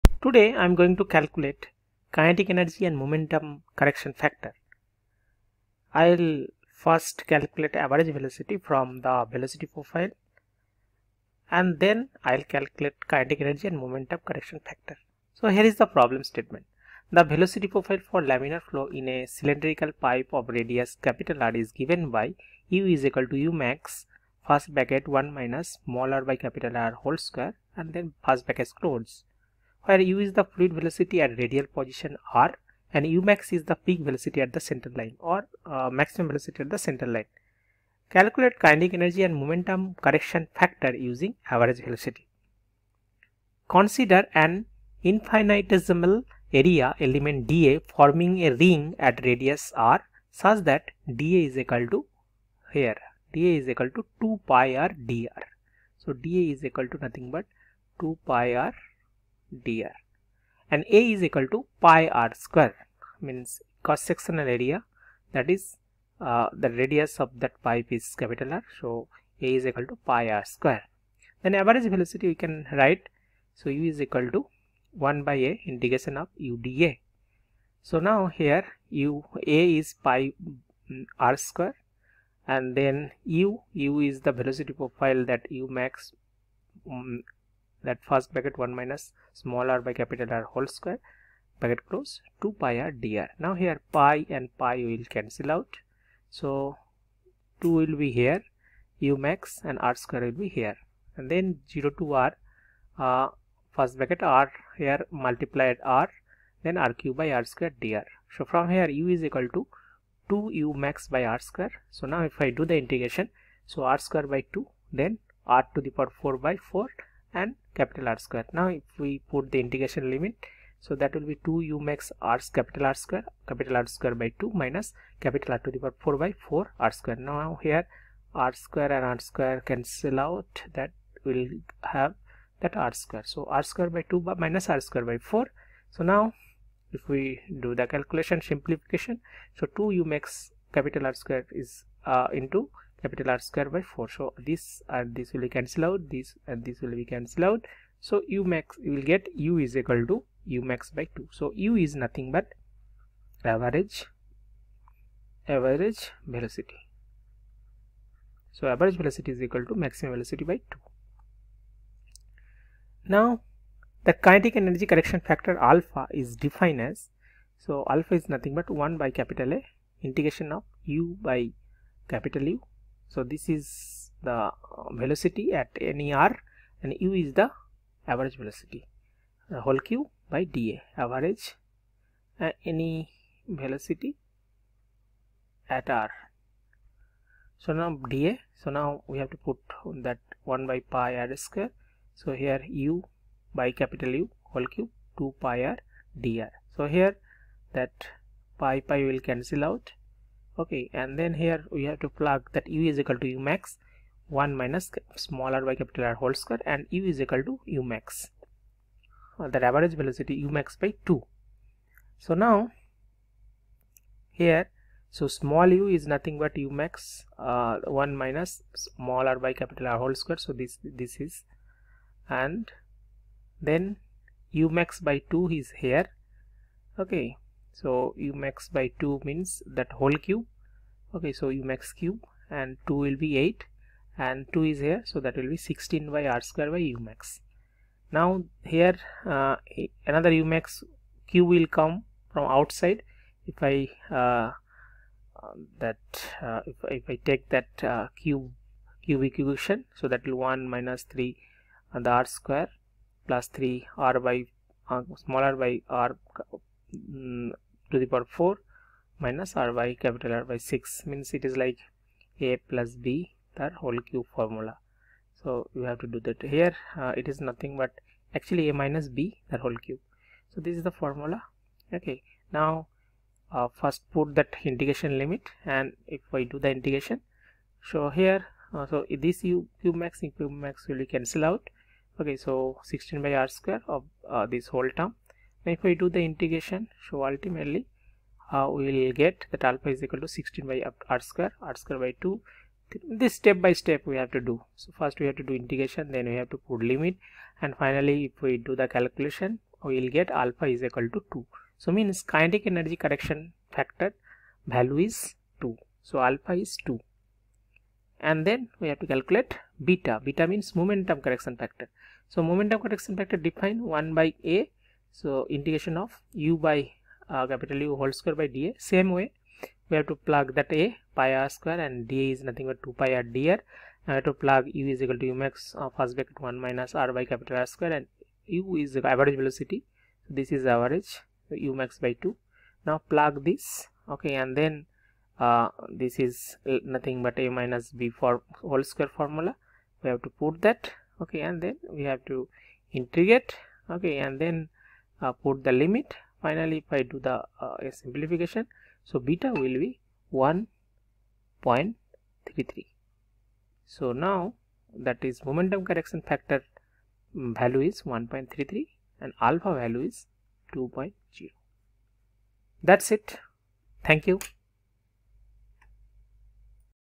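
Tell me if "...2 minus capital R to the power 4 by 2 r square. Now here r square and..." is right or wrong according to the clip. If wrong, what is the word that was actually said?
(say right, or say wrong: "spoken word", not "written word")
wrong: "4", not "2".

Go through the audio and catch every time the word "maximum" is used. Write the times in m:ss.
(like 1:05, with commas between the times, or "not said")
0:35, 2:39.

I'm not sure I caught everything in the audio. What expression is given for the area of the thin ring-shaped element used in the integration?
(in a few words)
2 pi r dr.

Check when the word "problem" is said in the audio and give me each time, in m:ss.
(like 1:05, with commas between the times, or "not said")
0:15.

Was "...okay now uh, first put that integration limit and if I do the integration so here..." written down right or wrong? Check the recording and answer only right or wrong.
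right.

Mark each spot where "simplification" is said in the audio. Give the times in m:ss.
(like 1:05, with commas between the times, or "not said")
2:18, 5:47.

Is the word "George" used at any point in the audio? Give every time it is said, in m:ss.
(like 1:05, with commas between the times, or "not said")
not said.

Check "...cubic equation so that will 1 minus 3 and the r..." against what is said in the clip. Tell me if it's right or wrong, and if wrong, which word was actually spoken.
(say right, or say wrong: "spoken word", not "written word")
right.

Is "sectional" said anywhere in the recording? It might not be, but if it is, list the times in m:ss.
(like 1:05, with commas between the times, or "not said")
1:04.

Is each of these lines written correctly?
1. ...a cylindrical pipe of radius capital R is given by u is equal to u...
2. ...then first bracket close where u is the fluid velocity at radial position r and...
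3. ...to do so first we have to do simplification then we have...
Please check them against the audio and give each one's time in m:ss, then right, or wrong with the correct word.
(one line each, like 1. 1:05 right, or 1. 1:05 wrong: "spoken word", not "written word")
1. 0:19 right
2. 0:27 right
3. 4:54 wrong: "integration", not "simplification".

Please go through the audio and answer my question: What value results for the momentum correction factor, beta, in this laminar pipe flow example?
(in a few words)
1.33.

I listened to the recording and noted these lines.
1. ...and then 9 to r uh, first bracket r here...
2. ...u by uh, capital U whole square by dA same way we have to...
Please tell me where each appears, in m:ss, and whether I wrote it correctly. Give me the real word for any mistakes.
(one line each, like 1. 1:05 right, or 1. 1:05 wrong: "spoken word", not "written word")
1. 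1:41 wrong: "0", not "9"
2. 5:16 right.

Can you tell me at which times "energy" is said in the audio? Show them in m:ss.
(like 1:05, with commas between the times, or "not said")
0:02, 0:13, 0:38, 2:44, 5:02.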